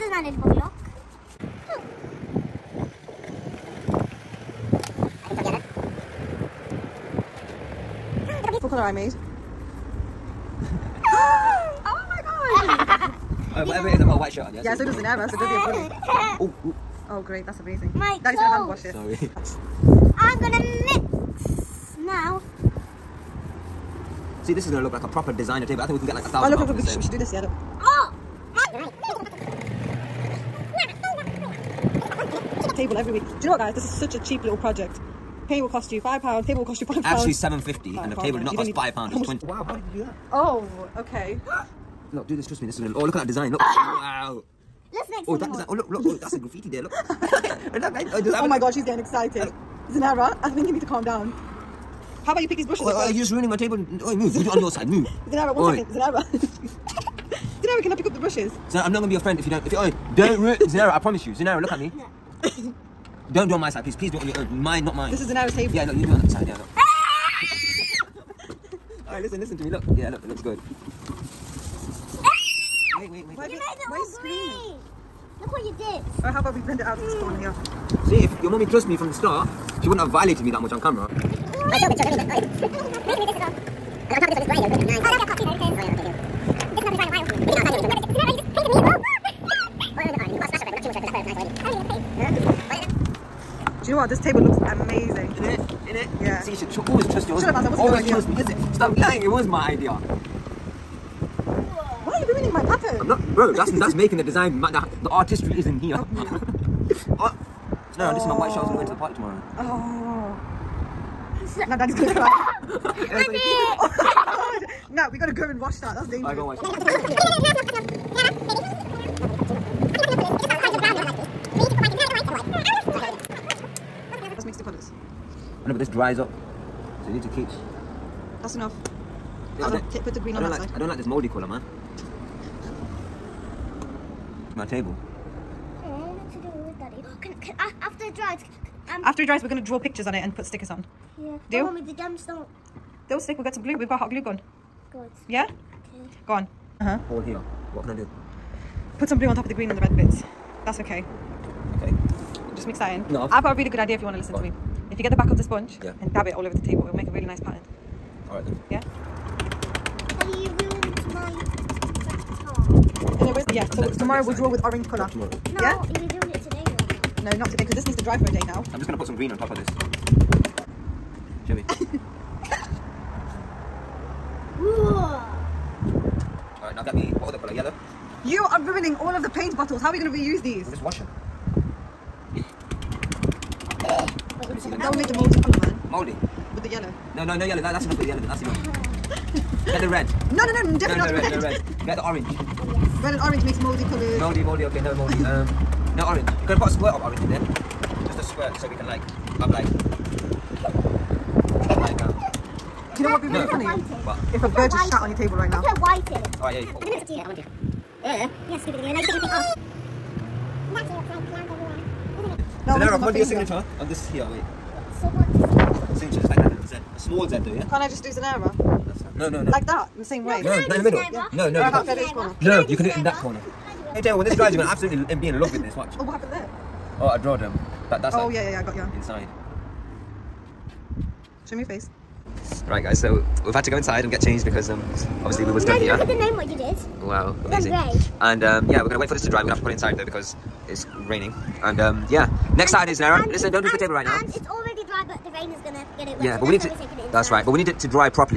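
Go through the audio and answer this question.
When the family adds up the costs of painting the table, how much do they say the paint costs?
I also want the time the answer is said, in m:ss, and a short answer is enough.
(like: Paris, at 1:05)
5 pounds, at 0:35.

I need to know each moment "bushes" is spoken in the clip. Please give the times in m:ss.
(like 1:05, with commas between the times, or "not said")
0:52, 0:58.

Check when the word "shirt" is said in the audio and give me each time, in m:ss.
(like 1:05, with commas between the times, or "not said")
0:14, 1:48.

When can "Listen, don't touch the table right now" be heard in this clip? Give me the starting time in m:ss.
4:03.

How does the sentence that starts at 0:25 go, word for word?
I think we can get like a thousand Oh, look, look, look, we should, we should do this, yeah, look.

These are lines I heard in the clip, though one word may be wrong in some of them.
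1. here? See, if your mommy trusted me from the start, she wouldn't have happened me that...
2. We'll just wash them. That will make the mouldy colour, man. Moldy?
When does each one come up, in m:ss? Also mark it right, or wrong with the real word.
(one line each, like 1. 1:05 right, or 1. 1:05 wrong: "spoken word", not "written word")
1. 1:18 wrong: "violated", not "happened"
2. 3:00 right.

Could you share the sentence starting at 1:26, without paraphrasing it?
This is not going to dry in a while.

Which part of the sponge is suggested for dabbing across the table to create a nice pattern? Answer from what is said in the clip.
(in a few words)
the back.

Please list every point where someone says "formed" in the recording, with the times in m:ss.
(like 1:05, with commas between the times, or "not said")
not said.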